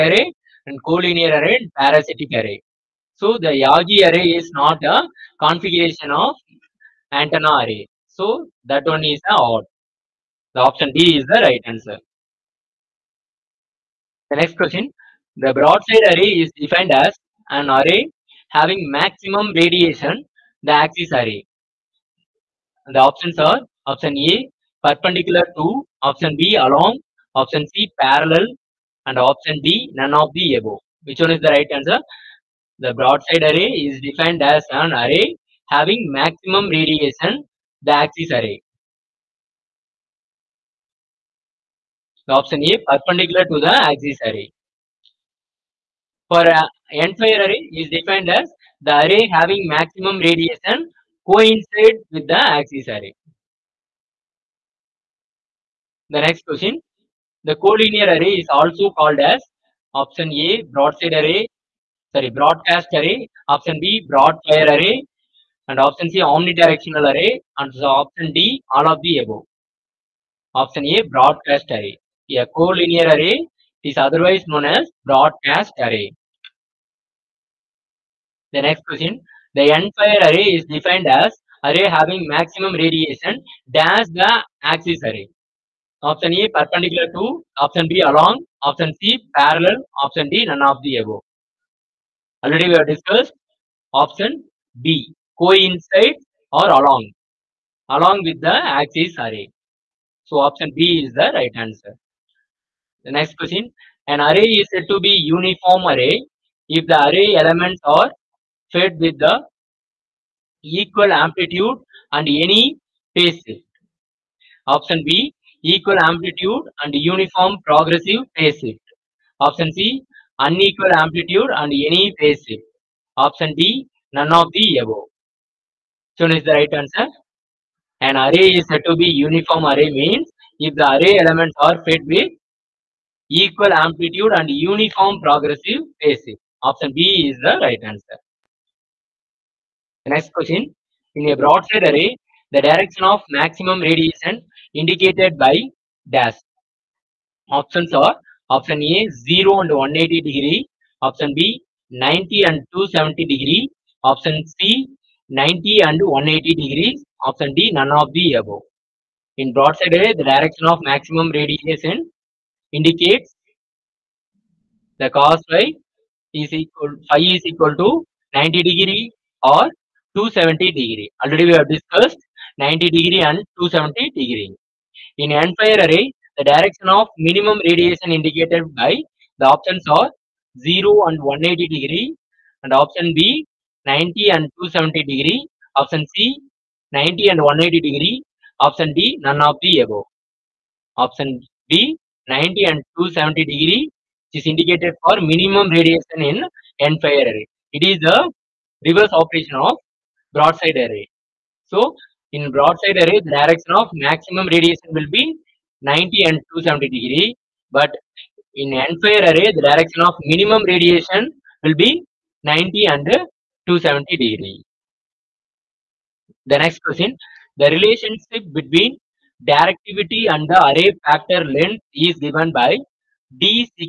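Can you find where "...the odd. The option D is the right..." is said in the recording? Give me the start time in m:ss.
0:09.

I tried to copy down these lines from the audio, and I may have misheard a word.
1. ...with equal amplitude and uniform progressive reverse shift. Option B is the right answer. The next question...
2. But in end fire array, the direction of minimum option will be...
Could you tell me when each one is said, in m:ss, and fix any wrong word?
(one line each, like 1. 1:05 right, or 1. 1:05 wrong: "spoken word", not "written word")
1. 2:12 wrong: "phase", not "reverse"
2. 3:27 wrong: "radiation", not "option".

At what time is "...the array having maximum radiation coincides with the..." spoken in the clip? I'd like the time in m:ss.
0:48.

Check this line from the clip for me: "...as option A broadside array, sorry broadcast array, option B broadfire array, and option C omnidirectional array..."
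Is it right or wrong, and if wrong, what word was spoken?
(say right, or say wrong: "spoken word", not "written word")
right.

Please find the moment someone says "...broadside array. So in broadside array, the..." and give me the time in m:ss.
3:20.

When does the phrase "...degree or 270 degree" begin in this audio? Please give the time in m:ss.
2:48.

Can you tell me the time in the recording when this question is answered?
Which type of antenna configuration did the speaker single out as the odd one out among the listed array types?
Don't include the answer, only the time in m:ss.
0:03.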